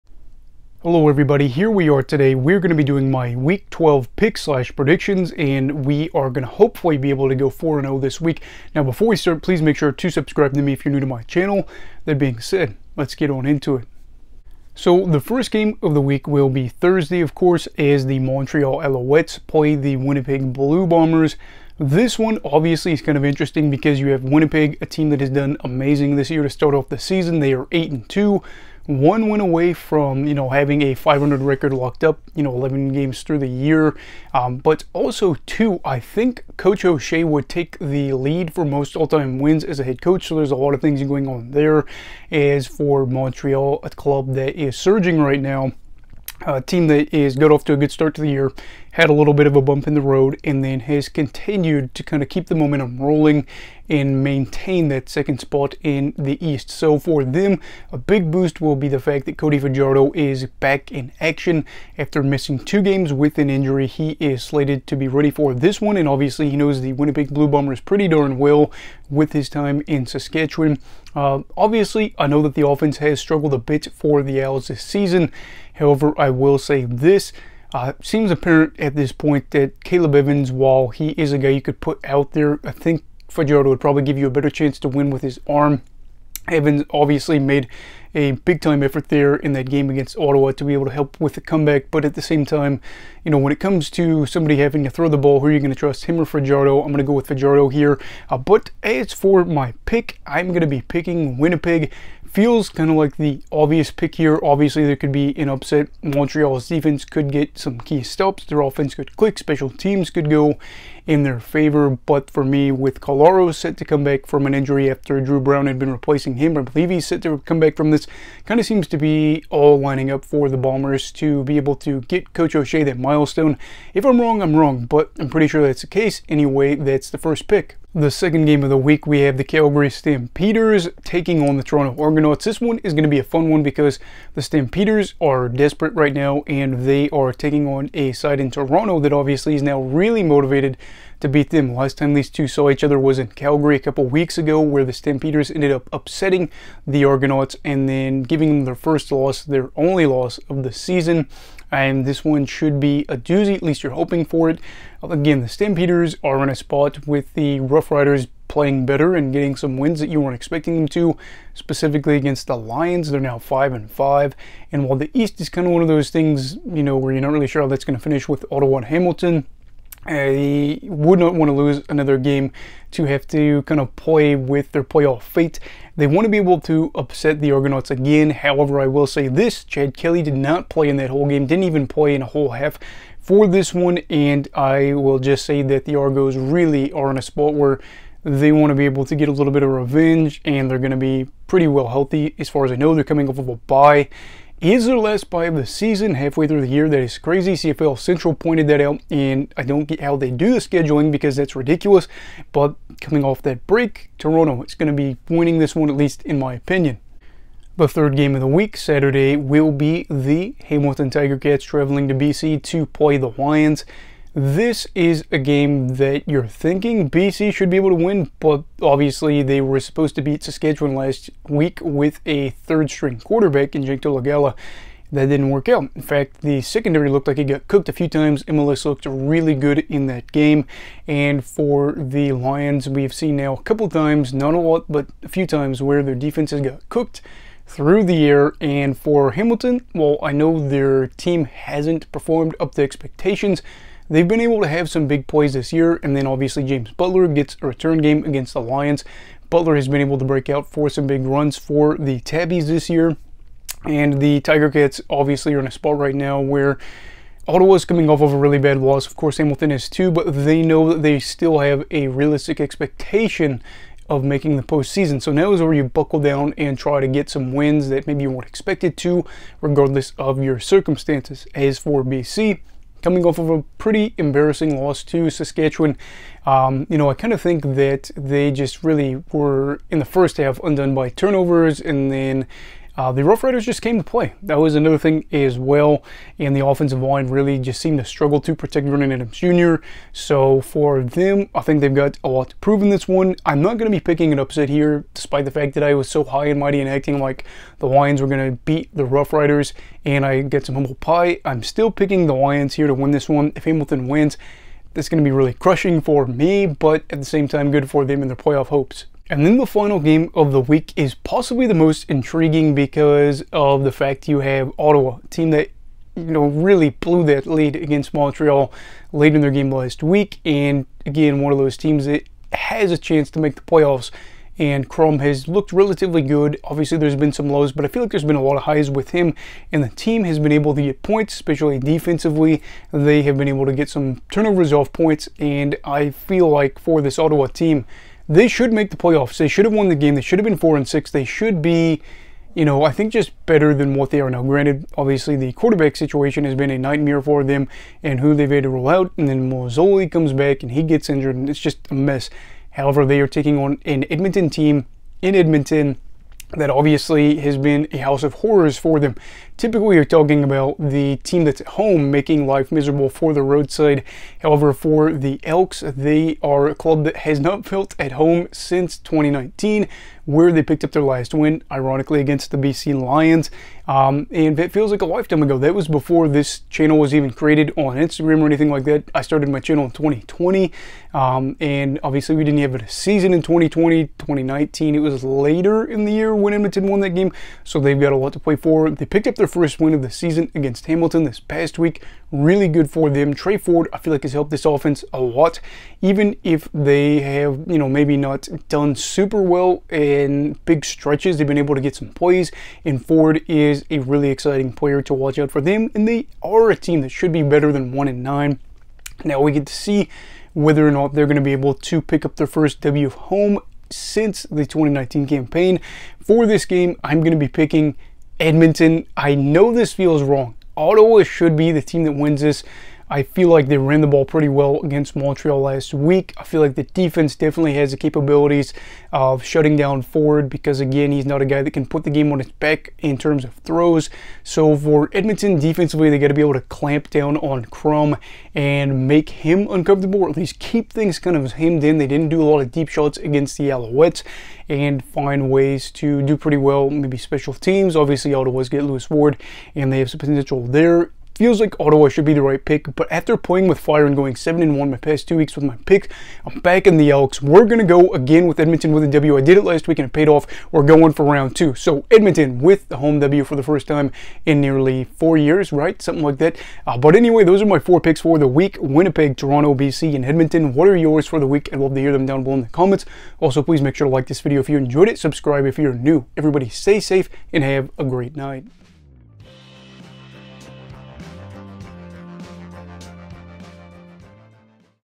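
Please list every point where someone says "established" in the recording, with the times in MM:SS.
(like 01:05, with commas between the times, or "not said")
not said.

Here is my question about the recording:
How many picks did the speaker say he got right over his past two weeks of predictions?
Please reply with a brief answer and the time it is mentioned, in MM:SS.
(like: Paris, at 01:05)
7, at 07:34.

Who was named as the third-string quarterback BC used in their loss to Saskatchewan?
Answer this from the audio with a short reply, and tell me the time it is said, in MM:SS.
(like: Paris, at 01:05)
Jake Dolegala, at 03:43.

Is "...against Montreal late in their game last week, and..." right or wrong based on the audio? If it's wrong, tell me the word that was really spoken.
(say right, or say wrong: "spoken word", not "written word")
right.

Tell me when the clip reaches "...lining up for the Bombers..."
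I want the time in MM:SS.
01:59.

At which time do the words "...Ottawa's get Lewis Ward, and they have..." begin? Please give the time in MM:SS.
07:28.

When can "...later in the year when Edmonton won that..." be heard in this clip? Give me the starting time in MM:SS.
06:25.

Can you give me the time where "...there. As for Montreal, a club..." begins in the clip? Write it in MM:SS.
00:41.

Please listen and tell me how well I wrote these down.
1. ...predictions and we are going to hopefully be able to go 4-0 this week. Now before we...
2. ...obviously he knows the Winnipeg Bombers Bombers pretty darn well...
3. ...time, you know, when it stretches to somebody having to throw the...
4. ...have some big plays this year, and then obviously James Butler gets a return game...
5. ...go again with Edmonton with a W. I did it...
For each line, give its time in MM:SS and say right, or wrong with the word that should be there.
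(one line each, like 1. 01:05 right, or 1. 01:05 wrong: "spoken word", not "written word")
1. 00:04 right
2. 01:06 wrong: "Blue", not "Bombers"
3. 01:32 wrong: "comes", not "stretches"
4. 04:04 right
5. 07:37 right.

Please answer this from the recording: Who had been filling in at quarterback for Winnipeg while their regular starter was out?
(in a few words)
Dru Brown.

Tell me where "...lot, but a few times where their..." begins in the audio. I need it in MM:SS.
03:54.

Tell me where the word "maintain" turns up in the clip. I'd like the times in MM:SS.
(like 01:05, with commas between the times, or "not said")
00:54.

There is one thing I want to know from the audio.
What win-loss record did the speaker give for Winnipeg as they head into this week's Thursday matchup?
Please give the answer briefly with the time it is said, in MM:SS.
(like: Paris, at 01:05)
8-2, at 00:27.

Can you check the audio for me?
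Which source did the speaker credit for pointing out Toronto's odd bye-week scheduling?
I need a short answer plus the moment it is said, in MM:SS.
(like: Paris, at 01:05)
CFL Central, at 03:17.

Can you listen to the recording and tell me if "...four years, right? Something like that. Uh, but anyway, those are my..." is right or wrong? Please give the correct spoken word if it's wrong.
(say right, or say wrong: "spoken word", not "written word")
right.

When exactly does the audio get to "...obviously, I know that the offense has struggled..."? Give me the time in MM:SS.
01:11.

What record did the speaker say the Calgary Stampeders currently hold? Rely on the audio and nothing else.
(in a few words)
5-5.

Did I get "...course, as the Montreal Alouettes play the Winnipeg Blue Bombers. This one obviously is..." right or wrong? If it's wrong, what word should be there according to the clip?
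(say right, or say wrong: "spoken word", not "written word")
right.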